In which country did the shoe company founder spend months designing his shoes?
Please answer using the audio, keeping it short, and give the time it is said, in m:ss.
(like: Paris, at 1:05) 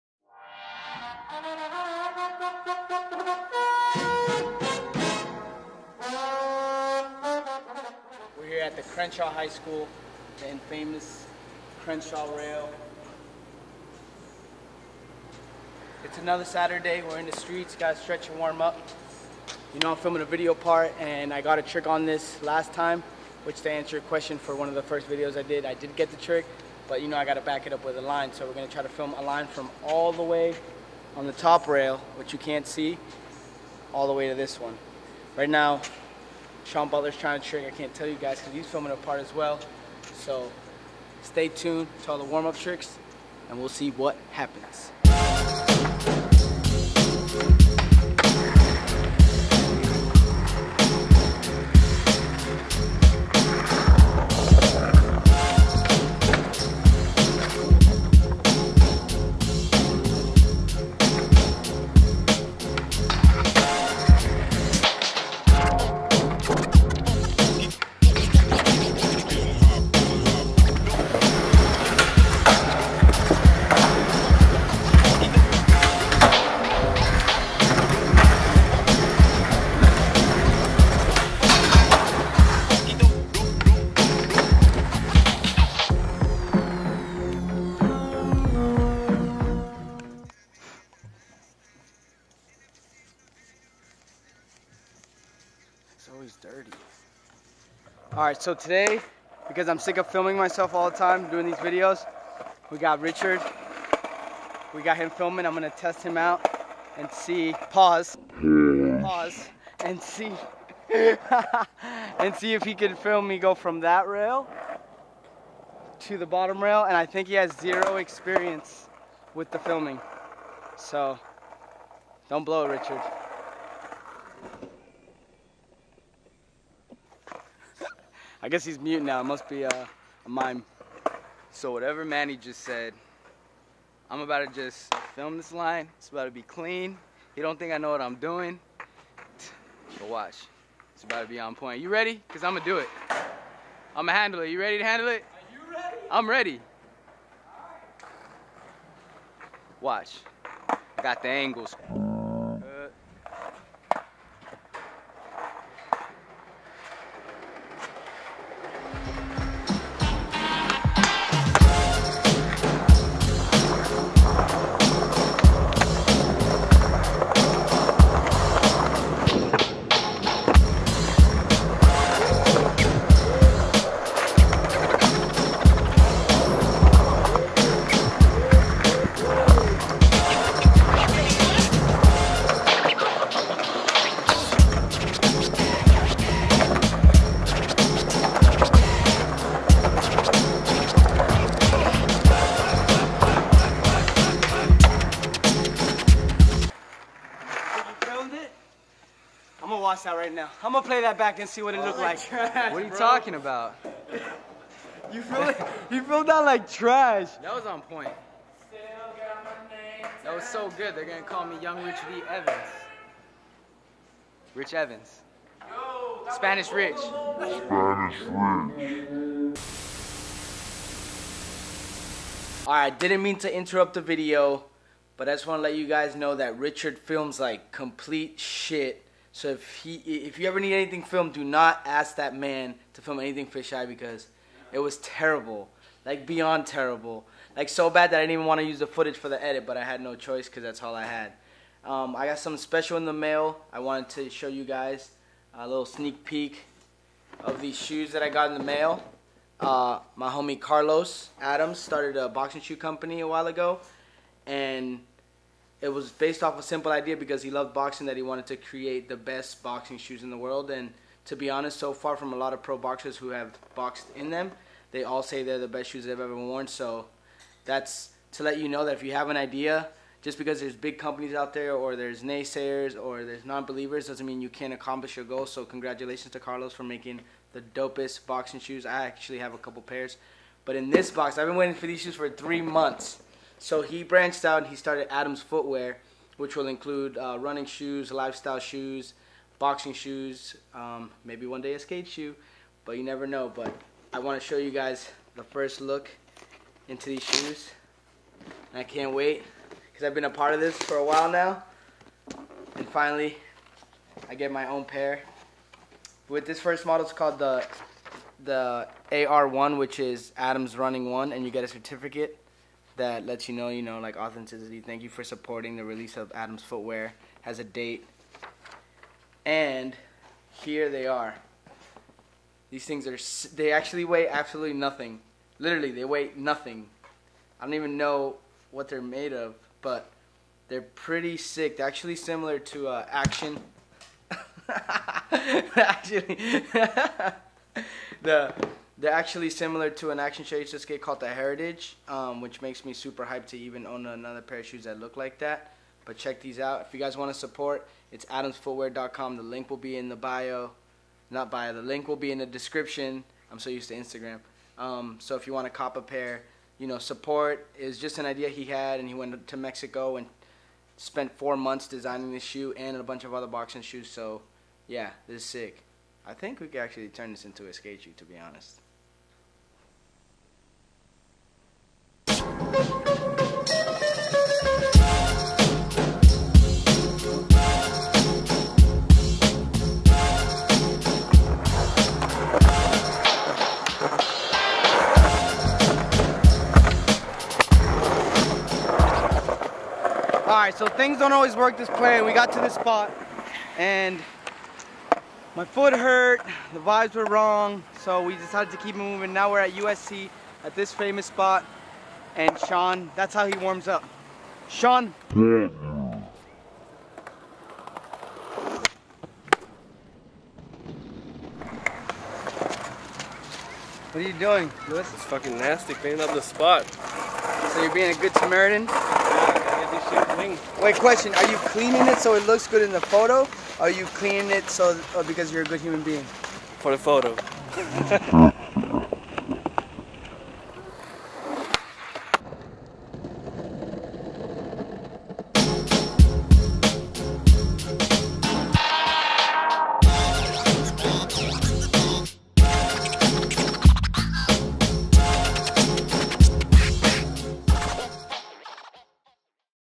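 Mexico, at 5:59.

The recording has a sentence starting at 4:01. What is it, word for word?
Um, I got something special in the mail.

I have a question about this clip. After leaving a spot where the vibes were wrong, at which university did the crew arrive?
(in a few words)
USC.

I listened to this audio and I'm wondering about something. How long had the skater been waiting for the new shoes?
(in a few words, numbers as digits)
three months.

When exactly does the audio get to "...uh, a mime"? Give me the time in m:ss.
2:09.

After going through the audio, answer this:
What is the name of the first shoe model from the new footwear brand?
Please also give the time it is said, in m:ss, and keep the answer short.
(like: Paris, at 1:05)
AR1, at 5:09.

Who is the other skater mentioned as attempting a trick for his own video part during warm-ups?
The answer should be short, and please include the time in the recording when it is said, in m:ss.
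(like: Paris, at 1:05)
Shawn Butler, at 0:36.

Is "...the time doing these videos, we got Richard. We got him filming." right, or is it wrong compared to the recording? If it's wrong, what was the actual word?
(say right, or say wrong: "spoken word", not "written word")
right.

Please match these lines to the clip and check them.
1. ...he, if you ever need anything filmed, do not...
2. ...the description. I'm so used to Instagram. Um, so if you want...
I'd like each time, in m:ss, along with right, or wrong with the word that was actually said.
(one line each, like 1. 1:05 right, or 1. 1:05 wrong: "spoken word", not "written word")
1. 3:49 right
2. 5:52 right.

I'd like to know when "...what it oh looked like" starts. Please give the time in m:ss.
3:21.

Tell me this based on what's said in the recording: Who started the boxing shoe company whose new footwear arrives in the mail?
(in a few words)
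Carlos Adams.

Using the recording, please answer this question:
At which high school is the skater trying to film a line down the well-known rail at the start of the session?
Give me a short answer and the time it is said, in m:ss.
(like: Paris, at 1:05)
Crenshaw High School, at 0:08.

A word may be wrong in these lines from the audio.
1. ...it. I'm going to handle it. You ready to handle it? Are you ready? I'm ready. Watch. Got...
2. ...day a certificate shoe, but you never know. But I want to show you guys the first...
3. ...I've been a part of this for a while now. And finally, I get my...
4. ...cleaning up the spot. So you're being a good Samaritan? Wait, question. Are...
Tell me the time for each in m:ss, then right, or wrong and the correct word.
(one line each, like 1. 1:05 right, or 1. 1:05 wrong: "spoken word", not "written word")
1. 2:22 right
2. 4:51 wrong: "skate", not "certificate"
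3. 5:00 right
4. 6:55 right.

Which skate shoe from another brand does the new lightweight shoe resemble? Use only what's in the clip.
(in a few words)
the Heritage.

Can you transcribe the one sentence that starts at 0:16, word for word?
It's another Saturday, we're in the streets, gotta stretch and warm up.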